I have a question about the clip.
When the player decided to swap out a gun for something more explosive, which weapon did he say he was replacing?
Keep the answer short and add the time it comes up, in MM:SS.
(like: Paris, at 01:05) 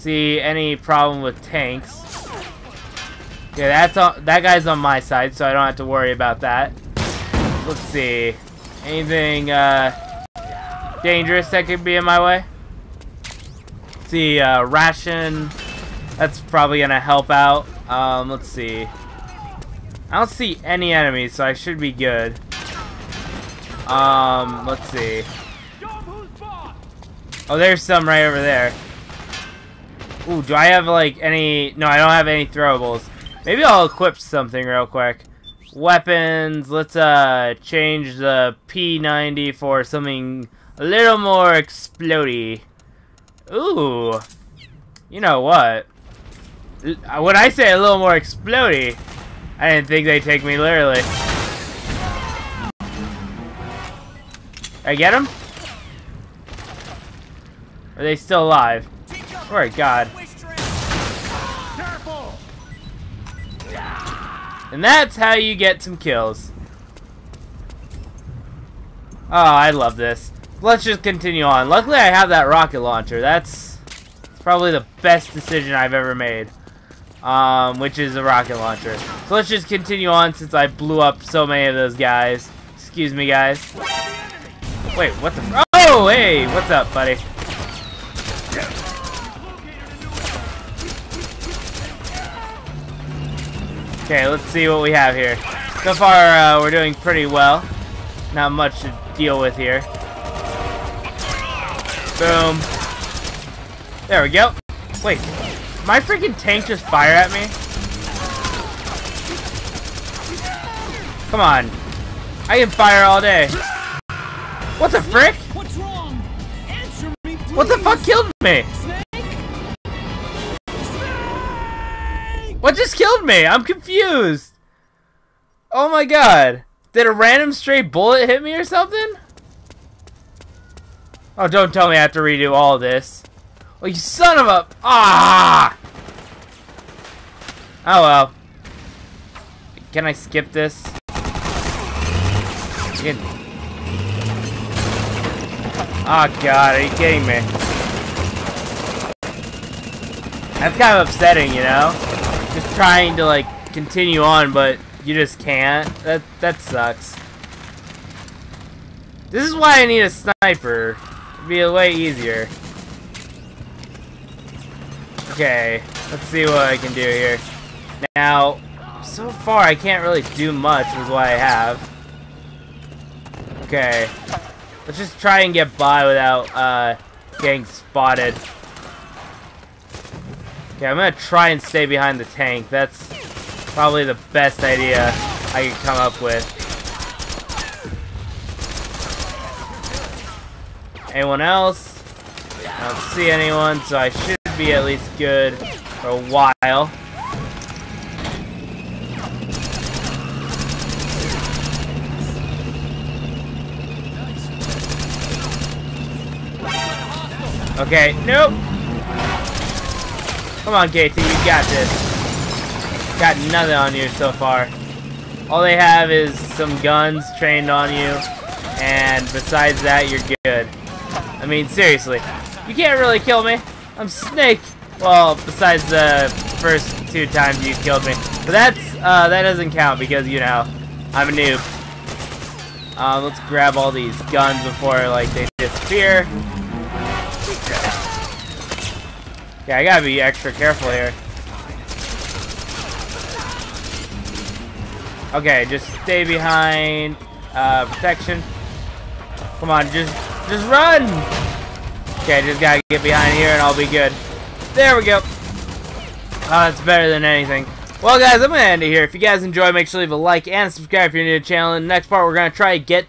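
P90, at 00:38.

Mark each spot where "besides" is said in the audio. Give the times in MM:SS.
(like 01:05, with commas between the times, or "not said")
03:39, 03:45.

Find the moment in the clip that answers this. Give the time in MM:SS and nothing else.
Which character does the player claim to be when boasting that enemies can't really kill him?
03:44.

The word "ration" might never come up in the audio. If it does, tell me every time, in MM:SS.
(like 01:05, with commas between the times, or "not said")
00:14.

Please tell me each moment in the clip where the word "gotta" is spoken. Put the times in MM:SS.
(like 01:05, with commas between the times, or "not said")
03:59, 04:12.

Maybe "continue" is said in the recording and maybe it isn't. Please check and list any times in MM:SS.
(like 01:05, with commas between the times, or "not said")
01:11, 01:19, 02:33.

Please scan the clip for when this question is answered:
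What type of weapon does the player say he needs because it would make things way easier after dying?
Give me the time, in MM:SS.
02:40.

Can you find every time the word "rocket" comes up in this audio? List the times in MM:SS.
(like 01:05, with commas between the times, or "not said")
01:12, 01:18.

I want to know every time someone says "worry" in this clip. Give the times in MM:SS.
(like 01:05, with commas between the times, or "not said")
00:05.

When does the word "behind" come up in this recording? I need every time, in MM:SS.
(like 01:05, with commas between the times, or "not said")
03:01, 04:06, 04:13.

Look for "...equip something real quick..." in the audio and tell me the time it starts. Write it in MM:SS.
00:33.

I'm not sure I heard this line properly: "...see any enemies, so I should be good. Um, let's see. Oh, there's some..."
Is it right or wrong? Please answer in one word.
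right.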